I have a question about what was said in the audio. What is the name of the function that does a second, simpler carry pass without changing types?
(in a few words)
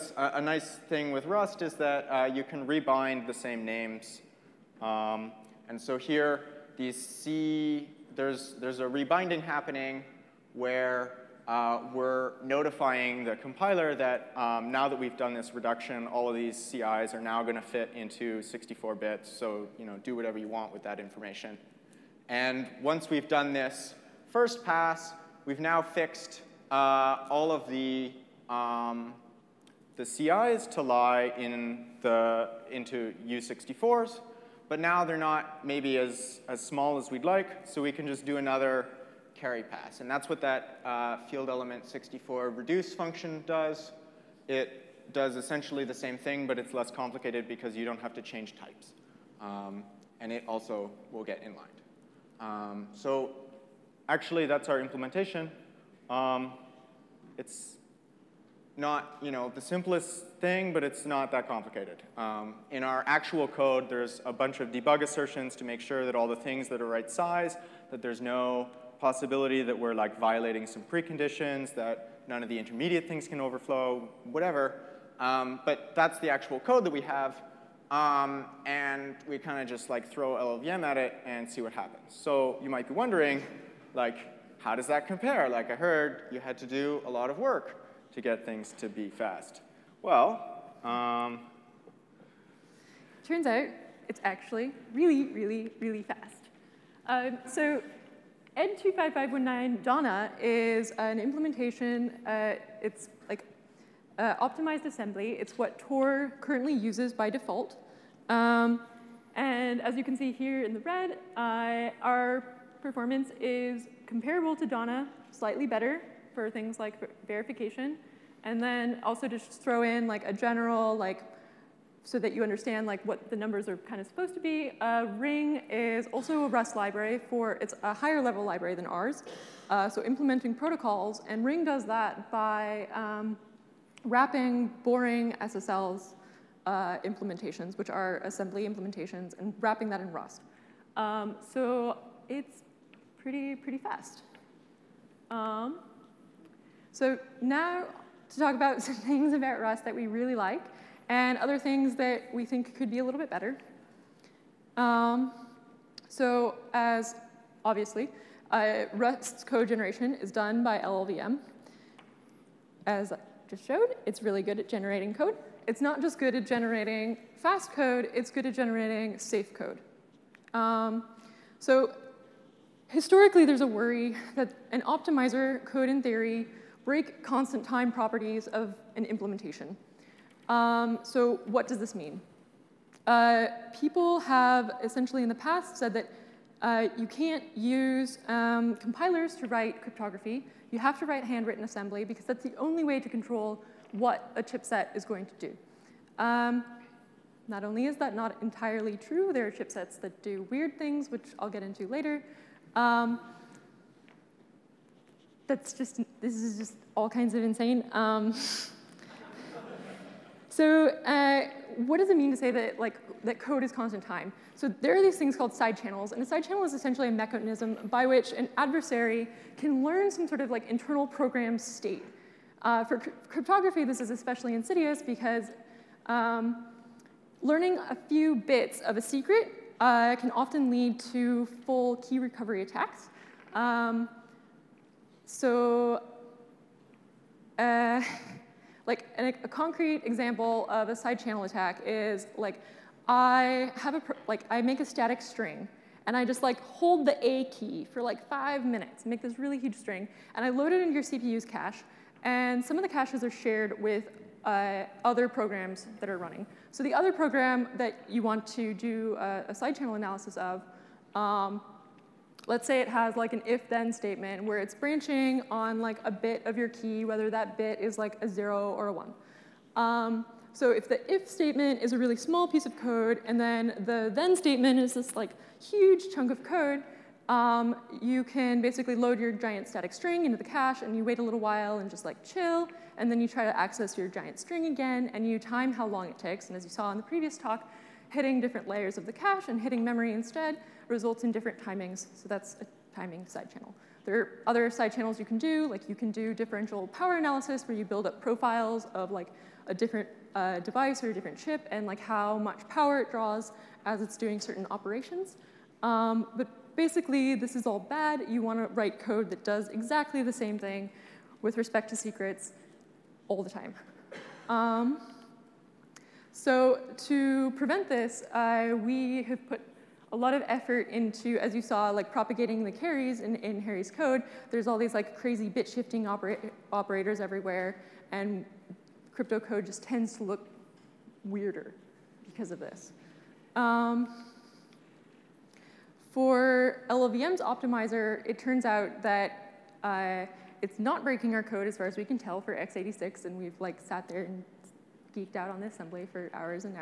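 field element 64 reduce.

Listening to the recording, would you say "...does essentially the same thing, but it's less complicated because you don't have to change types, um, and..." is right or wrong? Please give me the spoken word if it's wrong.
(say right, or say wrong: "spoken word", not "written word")
right.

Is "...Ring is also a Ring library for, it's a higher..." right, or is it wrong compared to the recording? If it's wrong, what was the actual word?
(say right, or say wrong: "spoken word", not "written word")
wrong: "Rust", not "Ring".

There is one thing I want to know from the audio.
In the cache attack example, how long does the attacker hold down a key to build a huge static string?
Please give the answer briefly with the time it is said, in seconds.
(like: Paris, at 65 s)
5 minutes, at 248 s.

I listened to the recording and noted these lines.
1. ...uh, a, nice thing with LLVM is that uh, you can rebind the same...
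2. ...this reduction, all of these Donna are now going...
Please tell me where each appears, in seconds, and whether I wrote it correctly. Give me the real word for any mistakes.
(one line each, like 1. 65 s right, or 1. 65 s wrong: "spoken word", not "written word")
1. 0 s wrong: "Rust", not "LLVM"
2. 15 s wrong: "CIs", not "Donna".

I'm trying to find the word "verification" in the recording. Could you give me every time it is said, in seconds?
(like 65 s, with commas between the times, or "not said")
117 s.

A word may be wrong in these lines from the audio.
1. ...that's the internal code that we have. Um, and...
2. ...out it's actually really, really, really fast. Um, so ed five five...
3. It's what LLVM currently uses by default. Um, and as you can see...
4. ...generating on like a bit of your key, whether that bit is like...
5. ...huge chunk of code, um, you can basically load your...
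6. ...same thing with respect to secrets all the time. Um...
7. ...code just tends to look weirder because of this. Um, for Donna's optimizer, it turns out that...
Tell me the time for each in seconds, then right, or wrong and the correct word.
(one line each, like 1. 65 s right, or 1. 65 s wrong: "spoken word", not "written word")
1. 75 s wrong: "actual", not "internal"
2. 93 s wrong: "two", not "five"
3. 105 s wrong: "Tor", not "LLVM"
4. 264 s wrong: "branching", not "generating"
5. 275 s right
6. 310 s right
7. 329 s wrong: "LLVM", not "Donna".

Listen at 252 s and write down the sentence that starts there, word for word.
And some of the caches are shared with uh, other programs that are running.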